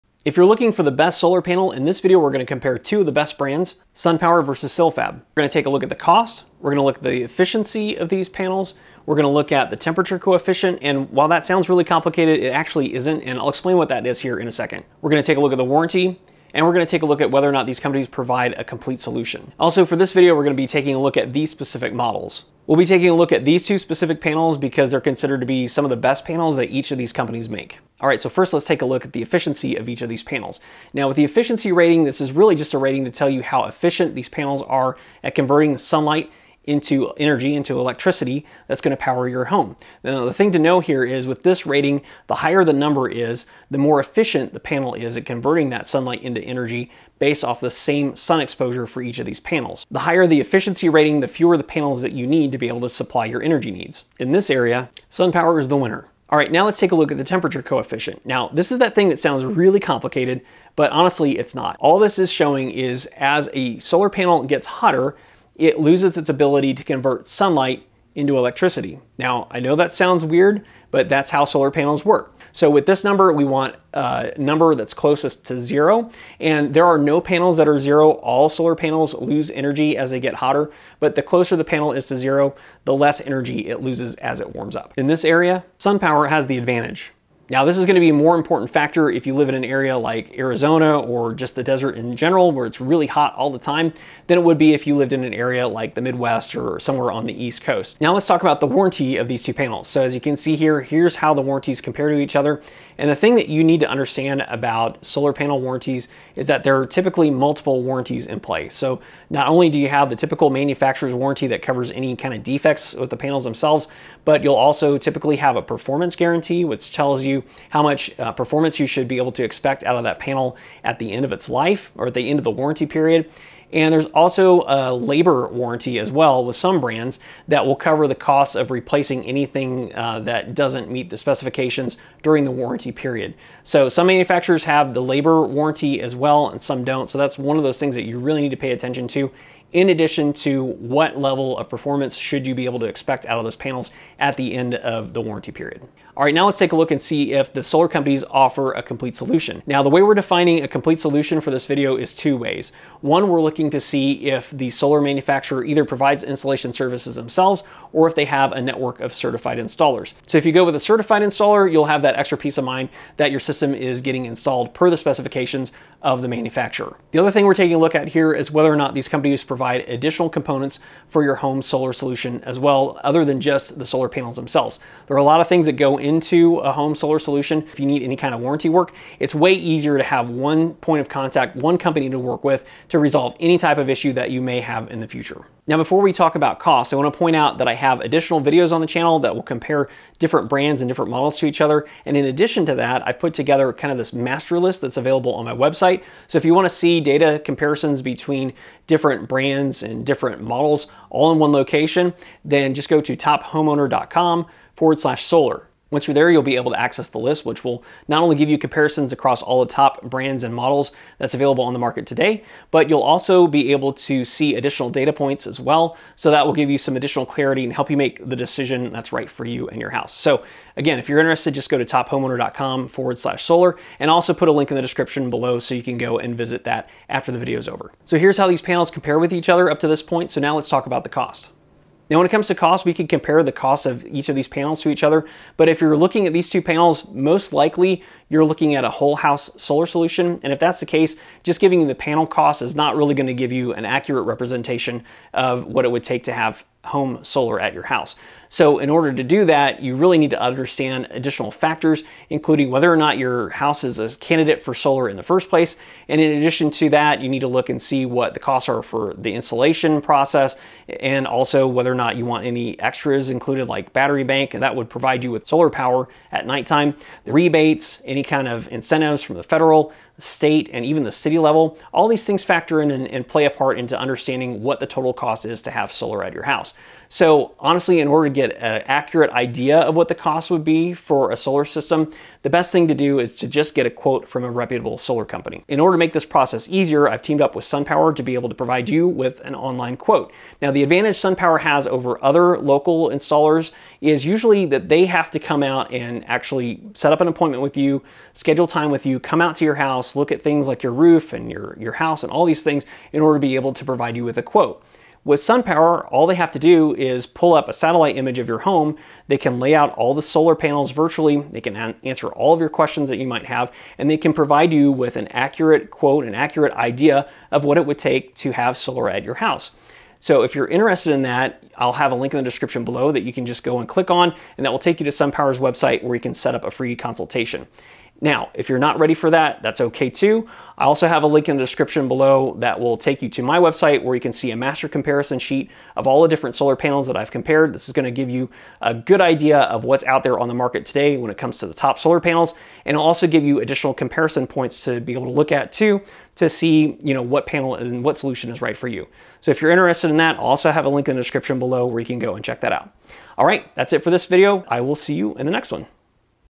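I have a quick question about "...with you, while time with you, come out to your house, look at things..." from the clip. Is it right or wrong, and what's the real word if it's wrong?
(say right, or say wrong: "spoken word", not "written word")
wrong: "schedule", not "while".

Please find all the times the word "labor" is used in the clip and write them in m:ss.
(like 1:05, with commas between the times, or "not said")
2:04, 2:15.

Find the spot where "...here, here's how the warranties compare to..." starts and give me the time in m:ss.
1:40.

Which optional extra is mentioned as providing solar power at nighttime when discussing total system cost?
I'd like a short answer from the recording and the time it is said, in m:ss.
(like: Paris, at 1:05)
Battery bank, at 4:23.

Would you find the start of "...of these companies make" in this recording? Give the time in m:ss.
0:26.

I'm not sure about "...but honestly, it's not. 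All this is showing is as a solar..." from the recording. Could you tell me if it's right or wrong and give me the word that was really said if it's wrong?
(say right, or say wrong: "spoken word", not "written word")
right.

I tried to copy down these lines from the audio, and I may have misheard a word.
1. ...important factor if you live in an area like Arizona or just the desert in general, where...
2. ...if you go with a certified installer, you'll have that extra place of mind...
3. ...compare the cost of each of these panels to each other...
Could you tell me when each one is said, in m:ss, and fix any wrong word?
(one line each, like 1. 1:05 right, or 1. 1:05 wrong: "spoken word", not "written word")
1. 1:28 right
2. 2:40 wrong: "peace", not "place"
3. 3:53 right.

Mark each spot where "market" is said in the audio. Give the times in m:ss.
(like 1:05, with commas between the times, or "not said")
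3:31, 5:40.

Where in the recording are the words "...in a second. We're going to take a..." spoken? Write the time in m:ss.
0:14.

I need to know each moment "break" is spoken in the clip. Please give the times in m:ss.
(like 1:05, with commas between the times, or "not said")
not said.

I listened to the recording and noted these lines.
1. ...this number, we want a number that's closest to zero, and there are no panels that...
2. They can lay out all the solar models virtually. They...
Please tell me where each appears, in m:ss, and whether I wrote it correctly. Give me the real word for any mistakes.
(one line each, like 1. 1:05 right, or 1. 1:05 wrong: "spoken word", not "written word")
1. 1:12 right
2. 5:09 wrong: "panels", not "models".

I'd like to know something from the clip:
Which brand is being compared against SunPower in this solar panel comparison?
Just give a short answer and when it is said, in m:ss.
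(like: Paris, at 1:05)
Silfab, at 0:04.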